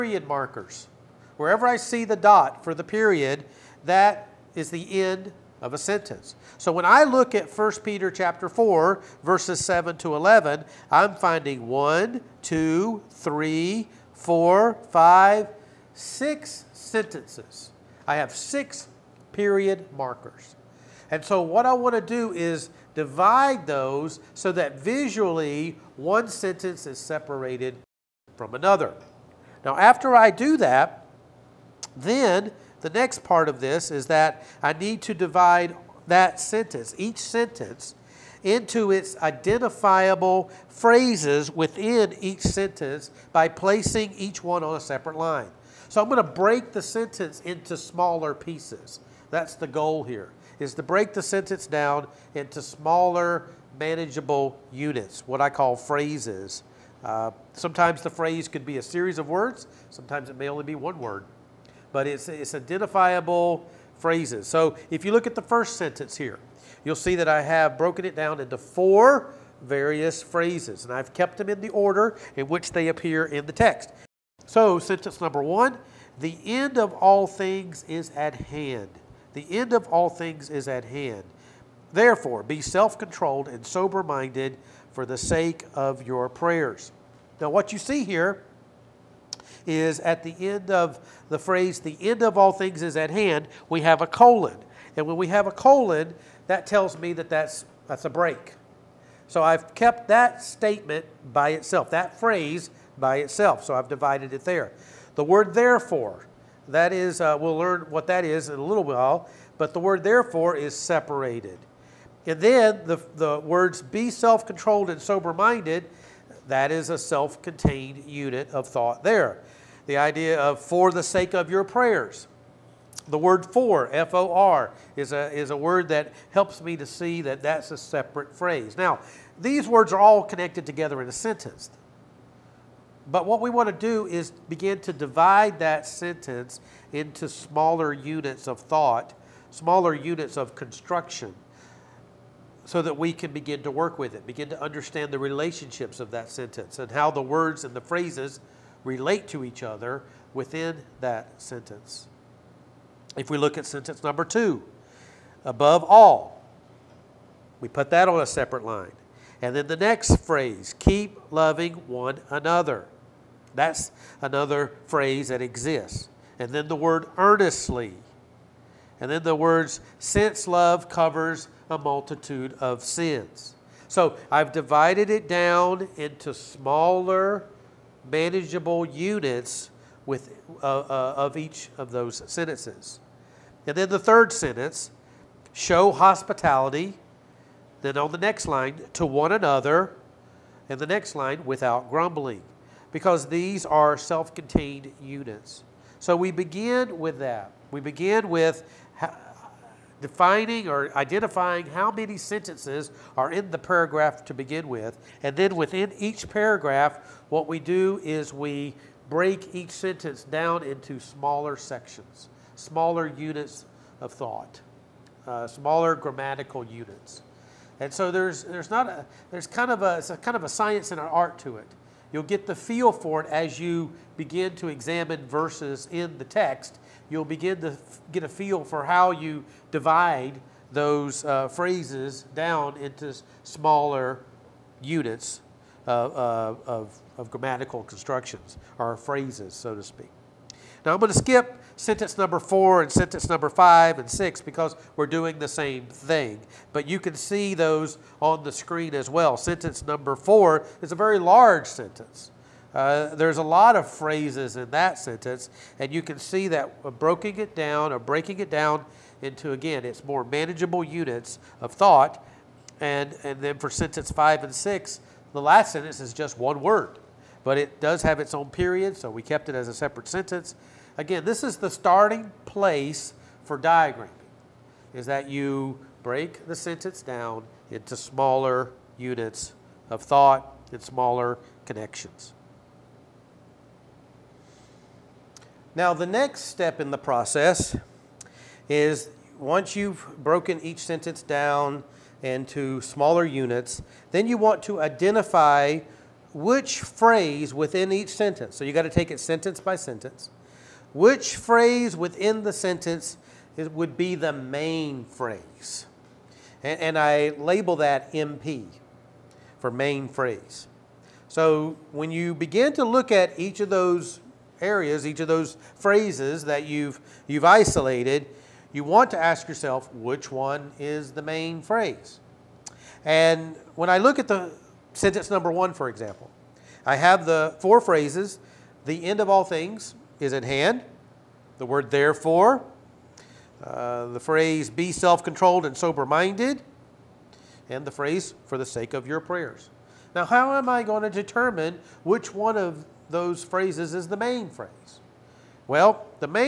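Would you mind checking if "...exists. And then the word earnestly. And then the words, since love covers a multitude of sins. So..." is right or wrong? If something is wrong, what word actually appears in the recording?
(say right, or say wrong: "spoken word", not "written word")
right.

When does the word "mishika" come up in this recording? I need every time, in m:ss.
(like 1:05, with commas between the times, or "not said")
not said.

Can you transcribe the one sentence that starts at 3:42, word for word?
You'll get the feel for it as you begin to examine verses in the text.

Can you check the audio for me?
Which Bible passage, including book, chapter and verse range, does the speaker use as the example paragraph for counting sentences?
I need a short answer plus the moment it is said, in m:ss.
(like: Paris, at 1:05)
1 Peter 4:7-11, at 0:07.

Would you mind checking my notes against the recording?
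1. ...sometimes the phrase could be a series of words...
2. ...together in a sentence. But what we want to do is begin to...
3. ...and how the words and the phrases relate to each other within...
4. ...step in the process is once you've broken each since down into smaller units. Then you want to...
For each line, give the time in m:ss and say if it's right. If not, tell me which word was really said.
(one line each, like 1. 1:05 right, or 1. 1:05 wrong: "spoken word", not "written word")
1. 0:57 right
2. 2:10 right
3. 2:26 right
4. 4:46 wrong: "sentence", not "since".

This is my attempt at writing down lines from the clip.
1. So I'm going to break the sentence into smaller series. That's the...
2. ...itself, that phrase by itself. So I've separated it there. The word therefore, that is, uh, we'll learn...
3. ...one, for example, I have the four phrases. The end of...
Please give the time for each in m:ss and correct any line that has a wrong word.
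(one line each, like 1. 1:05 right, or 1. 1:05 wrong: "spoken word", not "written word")
1. 0:45 wrong: "pieces", not "series"
2. 1:41 wrong: "divided", not "separated"
3. 5:25 right.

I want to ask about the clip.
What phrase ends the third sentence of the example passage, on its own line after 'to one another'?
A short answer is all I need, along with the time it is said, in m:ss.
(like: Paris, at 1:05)
without grumbling, at 3:11.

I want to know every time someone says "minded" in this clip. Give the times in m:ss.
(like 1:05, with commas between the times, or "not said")
1:24, 1:55, 5:36.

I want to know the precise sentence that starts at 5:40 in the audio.
Now, how am I going to determine which one of those phrases is the main phrase?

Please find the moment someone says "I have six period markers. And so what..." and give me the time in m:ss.
0:18.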